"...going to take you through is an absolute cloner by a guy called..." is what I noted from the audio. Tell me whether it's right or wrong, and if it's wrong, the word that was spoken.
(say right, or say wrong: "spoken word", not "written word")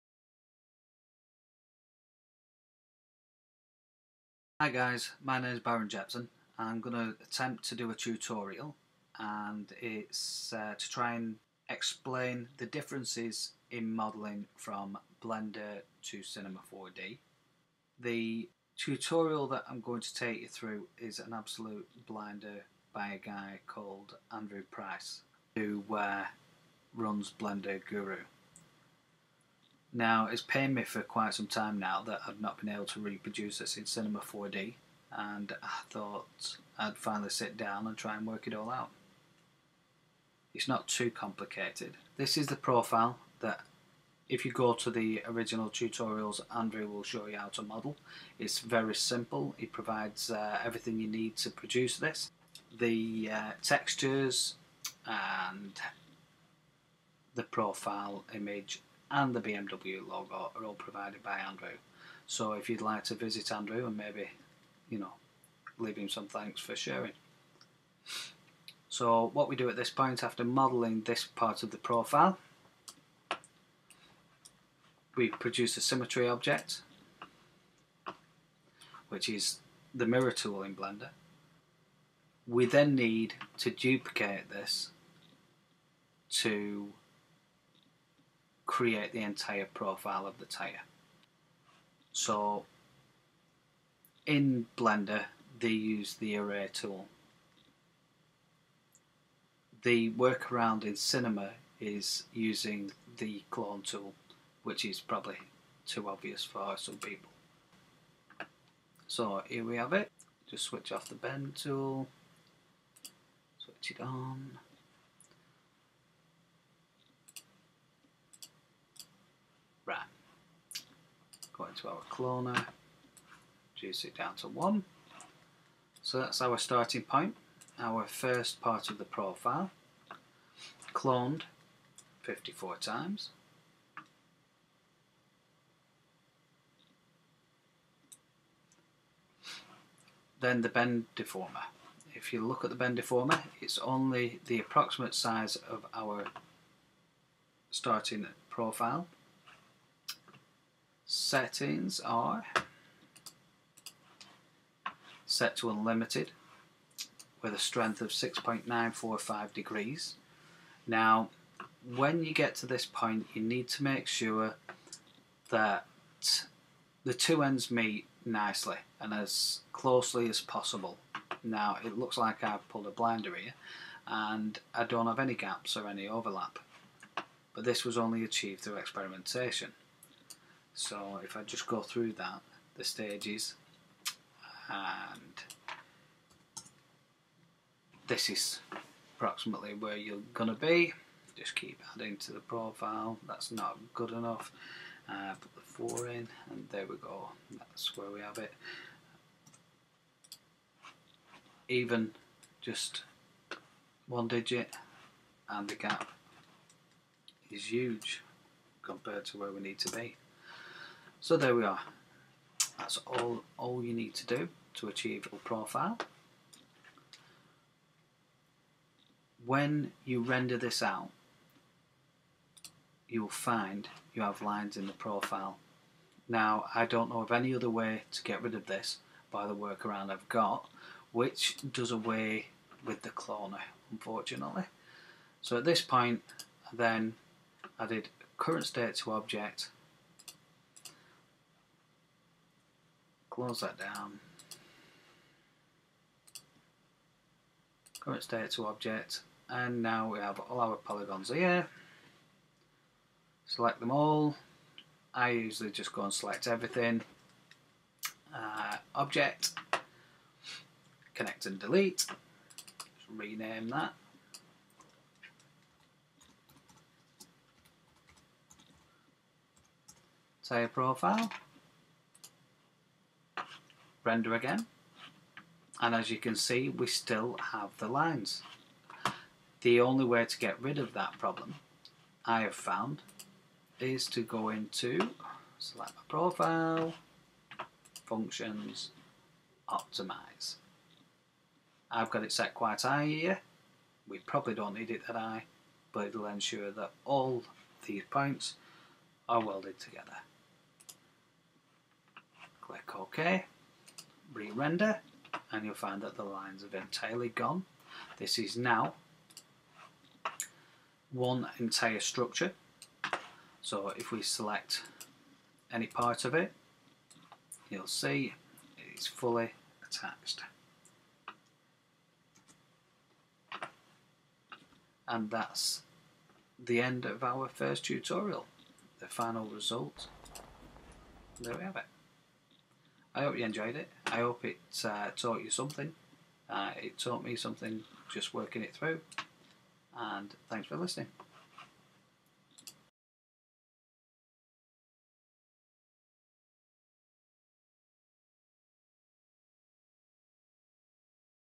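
wrong: "blinder", not "cloner".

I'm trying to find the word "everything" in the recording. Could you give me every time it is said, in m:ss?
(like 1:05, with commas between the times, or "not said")
0:50, 4:16.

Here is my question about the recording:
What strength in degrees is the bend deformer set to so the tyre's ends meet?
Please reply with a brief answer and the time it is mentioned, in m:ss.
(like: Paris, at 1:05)
6.945 degrees, at 2:38.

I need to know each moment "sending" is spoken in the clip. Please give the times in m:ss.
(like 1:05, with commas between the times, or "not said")
not said.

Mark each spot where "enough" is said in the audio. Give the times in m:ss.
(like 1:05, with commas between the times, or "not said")
3:14.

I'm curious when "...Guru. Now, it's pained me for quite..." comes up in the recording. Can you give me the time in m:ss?
0:27.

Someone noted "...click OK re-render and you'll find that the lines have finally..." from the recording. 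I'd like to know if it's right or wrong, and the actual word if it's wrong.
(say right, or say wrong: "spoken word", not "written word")
wrong: "entirely", not "finally".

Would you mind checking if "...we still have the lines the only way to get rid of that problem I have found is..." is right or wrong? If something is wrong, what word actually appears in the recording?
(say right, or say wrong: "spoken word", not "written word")
right.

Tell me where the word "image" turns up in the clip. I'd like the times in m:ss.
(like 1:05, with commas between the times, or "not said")
0:58.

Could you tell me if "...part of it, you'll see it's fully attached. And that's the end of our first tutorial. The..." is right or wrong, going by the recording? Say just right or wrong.
right.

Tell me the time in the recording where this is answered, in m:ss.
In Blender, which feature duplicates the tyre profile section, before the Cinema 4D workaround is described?
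1:36.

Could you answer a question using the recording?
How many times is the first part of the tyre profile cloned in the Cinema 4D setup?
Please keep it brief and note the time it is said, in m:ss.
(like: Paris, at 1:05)
54, at 2:12.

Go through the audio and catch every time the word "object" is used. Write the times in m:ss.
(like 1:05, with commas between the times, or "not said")
1:16, 3:59, 4:08, 4:18.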